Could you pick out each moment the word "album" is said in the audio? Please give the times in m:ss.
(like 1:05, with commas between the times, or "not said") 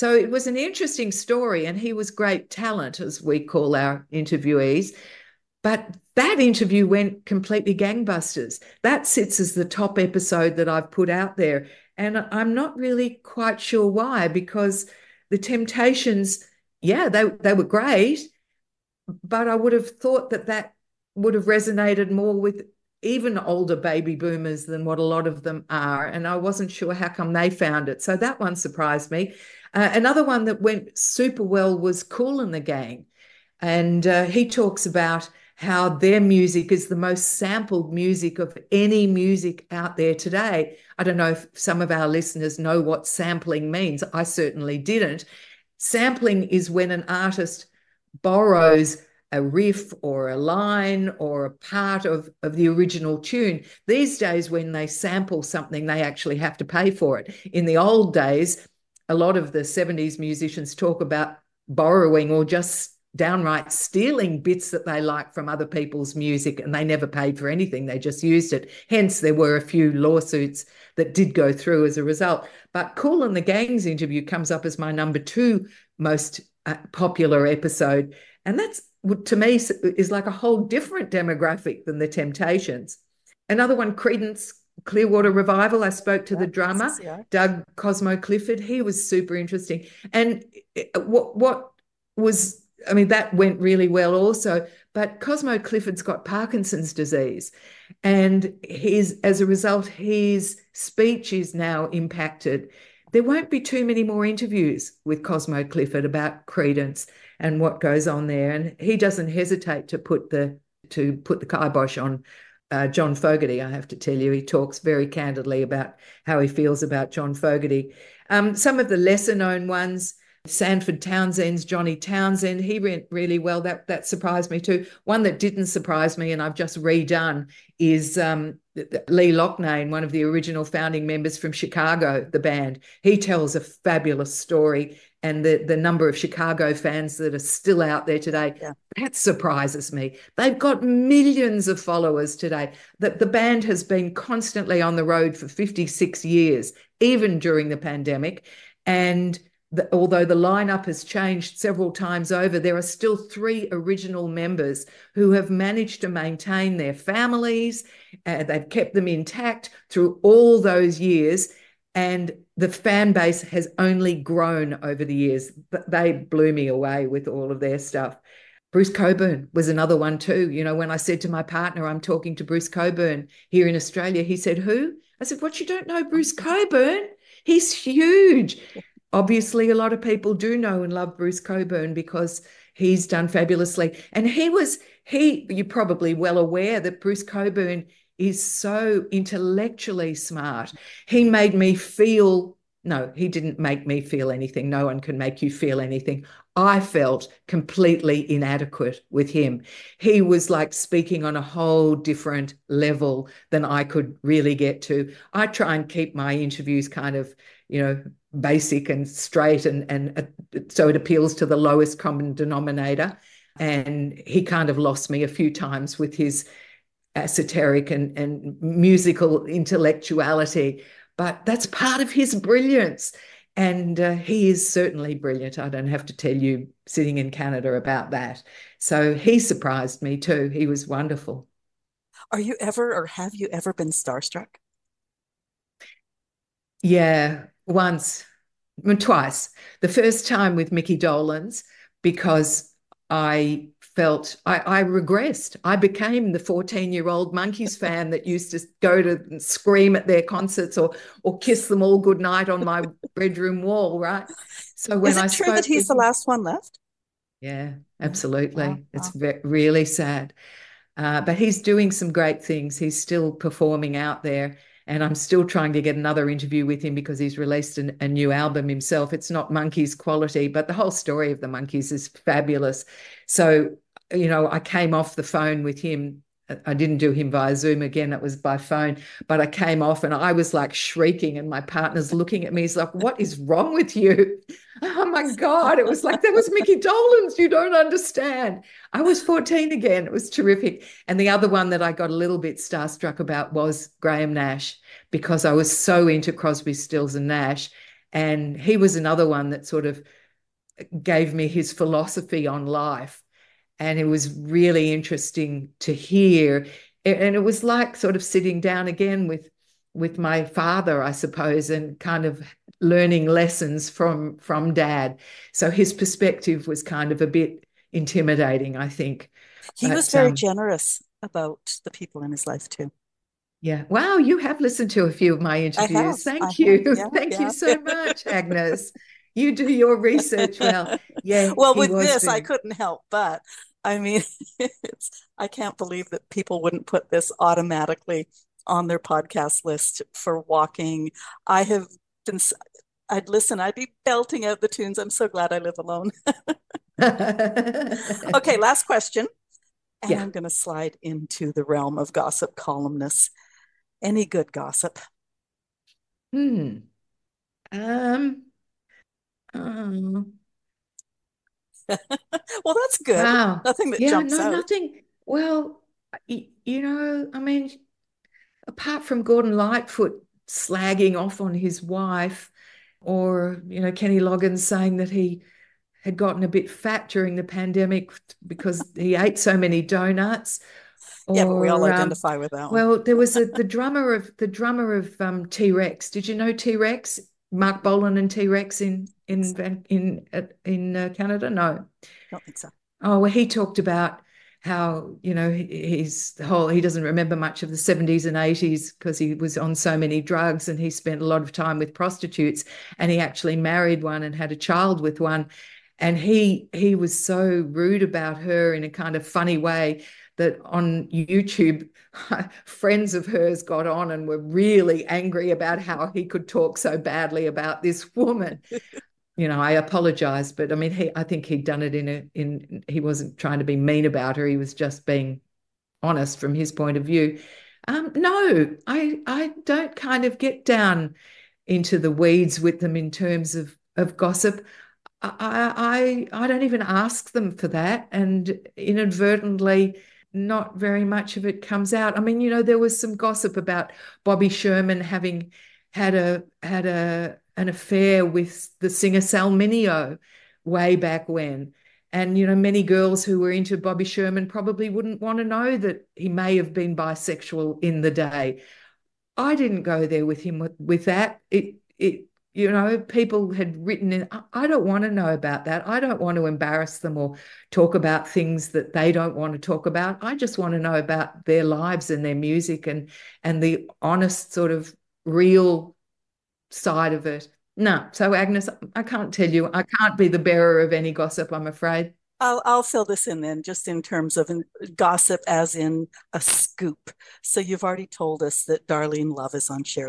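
4:28.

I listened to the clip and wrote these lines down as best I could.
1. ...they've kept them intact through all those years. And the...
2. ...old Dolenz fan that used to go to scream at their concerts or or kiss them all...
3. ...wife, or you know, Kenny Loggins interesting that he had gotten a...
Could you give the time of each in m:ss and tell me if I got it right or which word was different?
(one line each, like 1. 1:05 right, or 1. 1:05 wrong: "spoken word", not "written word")
1. 2:38 right
2. 4:07 wrong: "Monkees", not "Dolenz"
3. 6:11 wrong: "saying", not "interesting".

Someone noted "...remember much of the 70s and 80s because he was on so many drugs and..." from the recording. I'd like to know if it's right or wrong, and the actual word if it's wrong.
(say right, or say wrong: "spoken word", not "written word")
right.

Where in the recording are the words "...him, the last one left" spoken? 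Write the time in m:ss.
4:15.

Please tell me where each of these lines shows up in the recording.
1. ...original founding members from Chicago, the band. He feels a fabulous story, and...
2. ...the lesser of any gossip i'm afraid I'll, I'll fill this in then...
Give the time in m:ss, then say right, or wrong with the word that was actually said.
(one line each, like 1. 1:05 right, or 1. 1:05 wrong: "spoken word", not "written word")
1. 2:10 wrong: "tells", not "feels"
2. 8:00 wrong: "bearer", not "lesser".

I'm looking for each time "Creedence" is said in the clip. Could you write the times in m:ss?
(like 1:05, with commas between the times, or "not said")
1:23, 1:46.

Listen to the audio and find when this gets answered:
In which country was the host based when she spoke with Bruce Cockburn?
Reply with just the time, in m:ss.
2:53.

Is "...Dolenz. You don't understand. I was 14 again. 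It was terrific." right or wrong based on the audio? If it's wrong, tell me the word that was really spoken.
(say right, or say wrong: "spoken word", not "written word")
right.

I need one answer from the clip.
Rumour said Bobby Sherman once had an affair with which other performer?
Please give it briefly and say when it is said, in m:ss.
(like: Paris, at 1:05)
Sal Mineo, at 7:29.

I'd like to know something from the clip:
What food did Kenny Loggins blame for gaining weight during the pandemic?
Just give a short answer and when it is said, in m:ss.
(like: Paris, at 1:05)
Donuts, at 6:19.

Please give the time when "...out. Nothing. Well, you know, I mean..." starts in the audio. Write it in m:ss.
6:04.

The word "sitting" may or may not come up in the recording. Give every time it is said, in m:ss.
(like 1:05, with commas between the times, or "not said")
3:46, 5:08.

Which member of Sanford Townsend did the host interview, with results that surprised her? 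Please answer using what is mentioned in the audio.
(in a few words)
Johnny Townsend.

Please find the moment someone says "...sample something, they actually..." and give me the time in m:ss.
0:54.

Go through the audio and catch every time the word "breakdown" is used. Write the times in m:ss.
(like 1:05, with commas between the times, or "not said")
not said.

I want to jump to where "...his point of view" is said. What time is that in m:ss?
7:06.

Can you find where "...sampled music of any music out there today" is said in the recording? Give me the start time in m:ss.
0:37.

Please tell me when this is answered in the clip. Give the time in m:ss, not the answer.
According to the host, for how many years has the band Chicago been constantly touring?
2:25.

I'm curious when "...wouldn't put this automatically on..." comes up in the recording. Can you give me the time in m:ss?
5:36.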